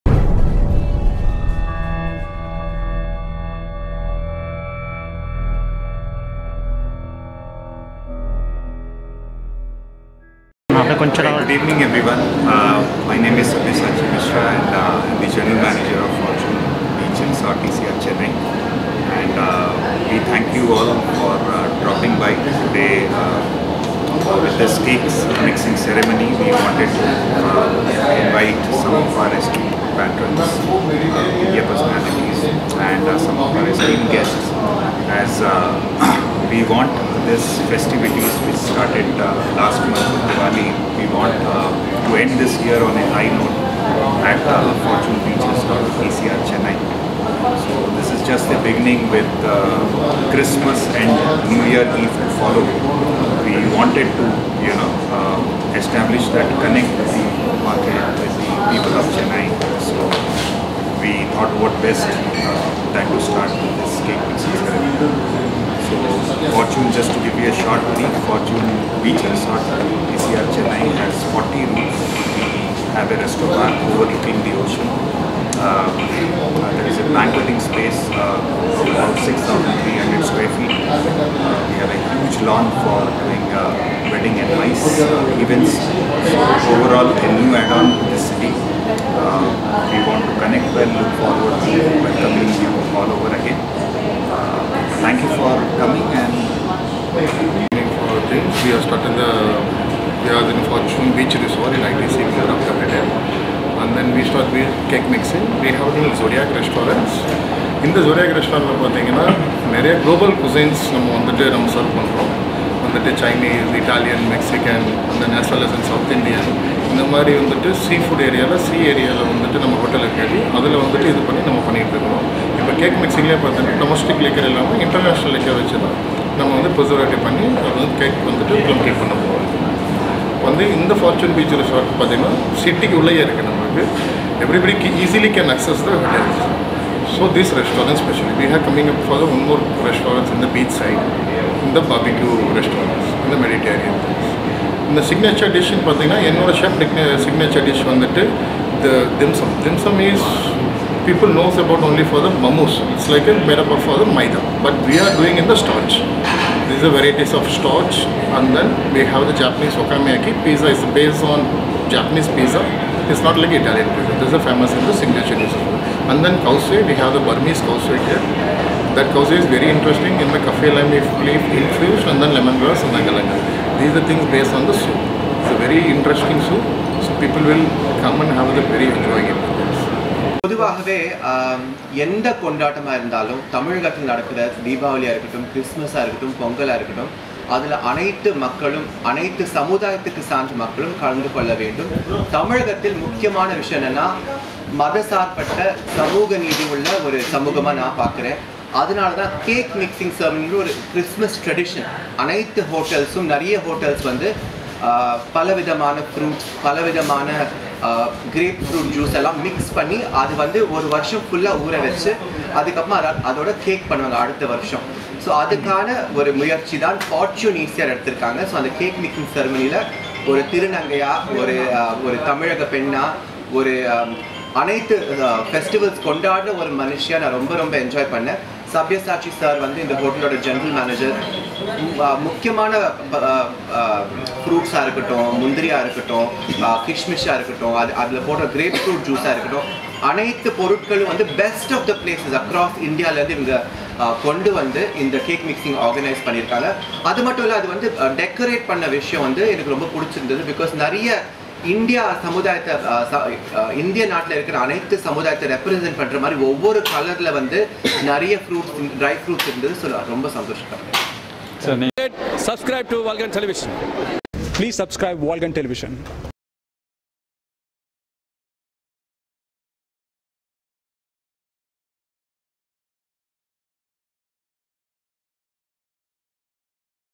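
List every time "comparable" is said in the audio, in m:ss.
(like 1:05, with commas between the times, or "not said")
not said.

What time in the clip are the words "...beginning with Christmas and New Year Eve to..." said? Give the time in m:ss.
0:48.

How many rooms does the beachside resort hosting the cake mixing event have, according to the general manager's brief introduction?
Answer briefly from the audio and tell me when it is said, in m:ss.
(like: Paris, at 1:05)
40, at 1:11.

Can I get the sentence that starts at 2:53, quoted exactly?
these are things based on the soup.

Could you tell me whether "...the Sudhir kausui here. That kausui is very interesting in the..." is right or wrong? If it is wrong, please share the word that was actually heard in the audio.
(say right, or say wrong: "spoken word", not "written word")
wrong: "Burmese", not "Sudhir".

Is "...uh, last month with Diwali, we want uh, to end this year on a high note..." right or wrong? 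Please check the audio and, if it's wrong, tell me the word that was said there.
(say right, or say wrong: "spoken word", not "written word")
right.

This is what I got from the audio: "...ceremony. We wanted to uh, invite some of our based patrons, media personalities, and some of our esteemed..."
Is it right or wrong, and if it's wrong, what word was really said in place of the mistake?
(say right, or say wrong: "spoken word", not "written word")
wrong: "esteemed", not "based".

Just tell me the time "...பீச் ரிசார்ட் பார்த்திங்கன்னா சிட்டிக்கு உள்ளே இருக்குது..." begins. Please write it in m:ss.
2:11.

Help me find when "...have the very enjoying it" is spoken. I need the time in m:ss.
2:58.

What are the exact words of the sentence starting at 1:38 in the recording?
We are starting the we are in Fortune Beach Resort in ITC Mura Capital.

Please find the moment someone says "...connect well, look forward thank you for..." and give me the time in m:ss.
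1:30.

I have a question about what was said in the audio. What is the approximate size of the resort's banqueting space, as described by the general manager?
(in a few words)
6,300 square feet.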